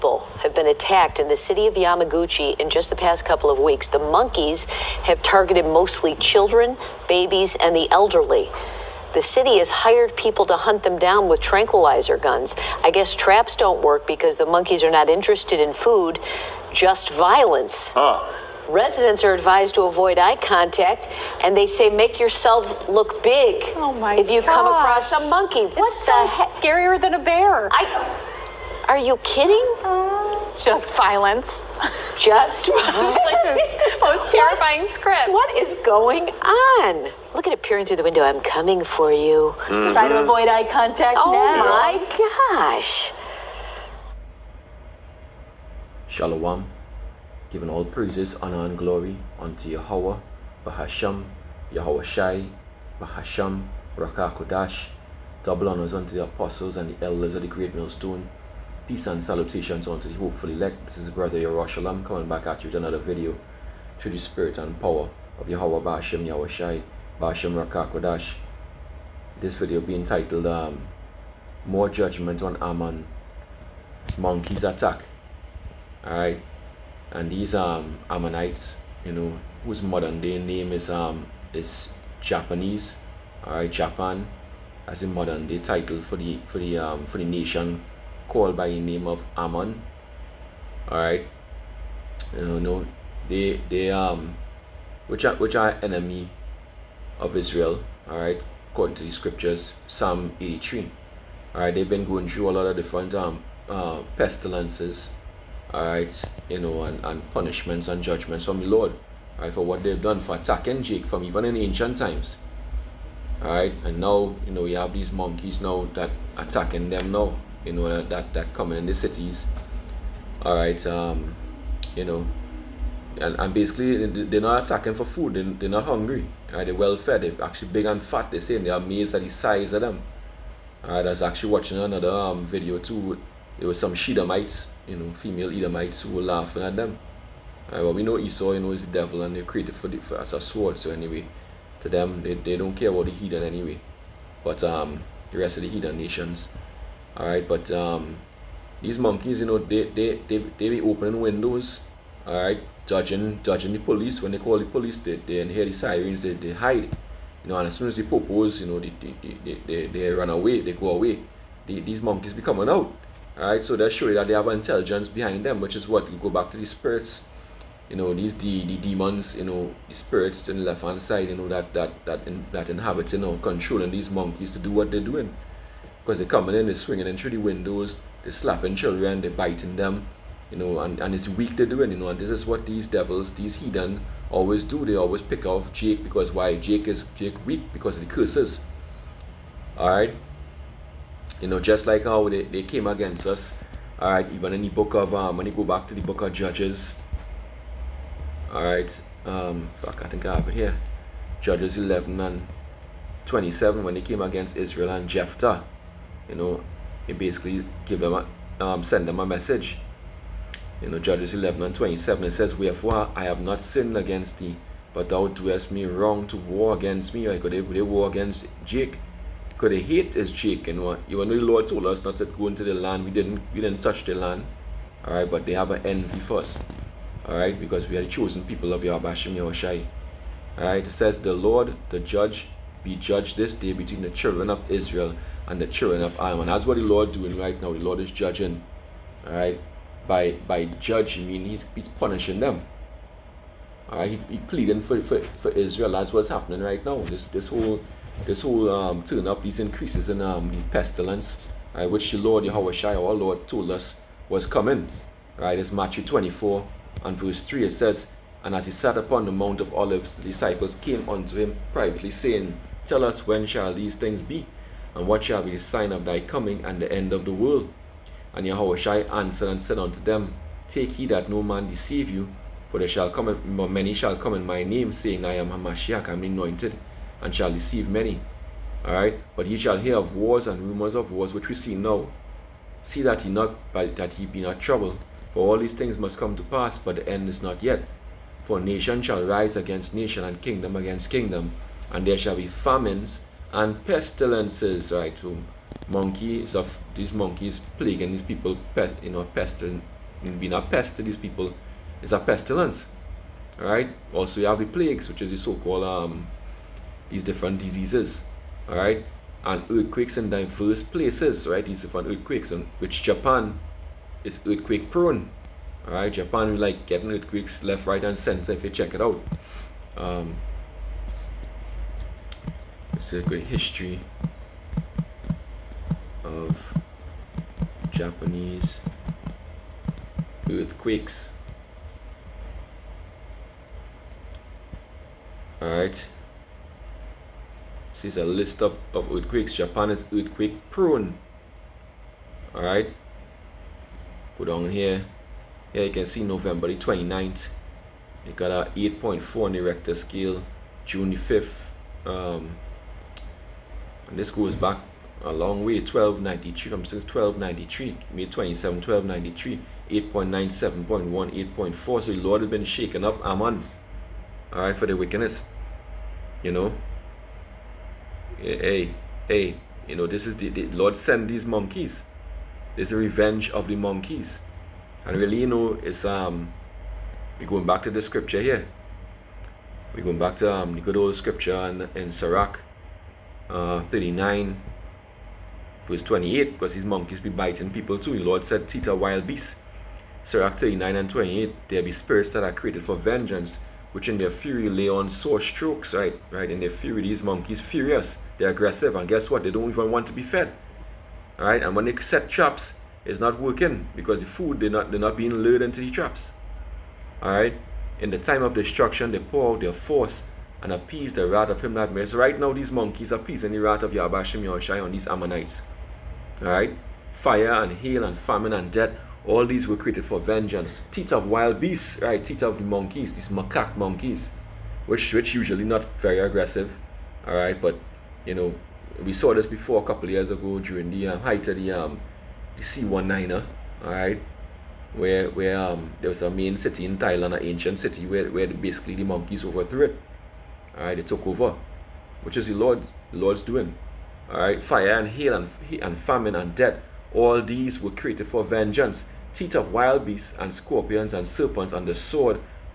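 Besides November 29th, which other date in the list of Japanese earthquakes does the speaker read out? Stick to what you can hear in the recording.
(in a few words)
June 5th.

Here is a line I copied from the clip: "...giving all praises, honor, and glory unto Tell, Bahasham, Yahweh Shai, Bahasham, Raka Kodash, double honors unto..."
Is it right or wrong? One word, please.
wrong.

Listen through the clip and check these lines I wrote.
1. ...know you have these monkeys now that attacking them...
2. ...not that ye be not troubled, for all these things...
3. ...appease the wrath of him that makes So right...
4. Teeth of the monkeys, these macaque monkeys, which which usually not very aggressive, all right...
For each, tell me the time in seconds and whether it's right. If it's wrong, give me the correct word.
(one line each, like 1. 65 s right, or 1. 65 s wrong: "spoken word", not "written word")
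1. 114 s right
2. 283 s right
3. 410 s right
4. 422 s right.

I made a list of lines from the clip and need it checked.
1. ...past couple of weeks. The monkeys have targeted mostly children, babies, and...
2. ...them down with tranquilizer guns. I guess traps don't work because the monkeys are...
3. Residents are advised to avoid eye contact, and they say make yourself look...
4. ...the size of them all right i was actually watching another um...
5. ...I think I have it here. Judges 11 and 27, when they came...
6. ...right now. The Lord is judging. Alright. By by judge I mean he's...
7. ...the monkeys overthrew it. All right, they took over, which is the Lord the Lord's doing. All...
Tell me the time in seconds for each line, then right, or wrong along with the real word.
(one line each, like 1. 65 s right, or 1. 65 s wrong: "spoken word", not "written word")
1. 3 s right
2. 10 s right
3. 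18 s right
4. 129 s right
5. 200 s right
6. 237 s right
7. 438 s right.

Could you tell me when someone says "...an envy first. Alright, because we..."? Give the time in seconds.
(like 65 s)
225 s.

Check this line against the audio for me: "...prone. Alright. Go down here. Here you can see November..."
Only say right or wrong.
right.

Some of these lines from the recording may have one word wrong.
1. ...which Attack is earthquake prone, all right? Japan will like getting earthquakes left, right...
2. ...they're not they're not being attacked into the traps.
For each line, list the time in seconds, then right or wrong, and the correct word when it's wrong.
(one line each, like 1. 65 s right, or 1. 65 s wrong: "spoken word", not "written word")
1. 312 s wrong: "Japan", not "Attack"
2. 404 s wrong: "lured", not "attacked".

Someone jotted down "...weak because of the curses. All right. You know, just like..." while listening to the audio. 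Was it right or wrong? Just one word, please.
right.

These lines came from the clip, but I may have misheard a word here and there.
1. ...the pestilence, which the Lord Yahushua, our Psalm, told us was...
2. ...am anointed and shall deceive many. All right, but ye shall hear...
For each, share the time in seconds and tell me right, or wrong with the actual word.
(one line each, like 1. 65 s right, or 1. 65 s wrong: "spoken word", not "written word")
1. 250 s wrong: "Lord", not "Psalm"
2. 276 s right.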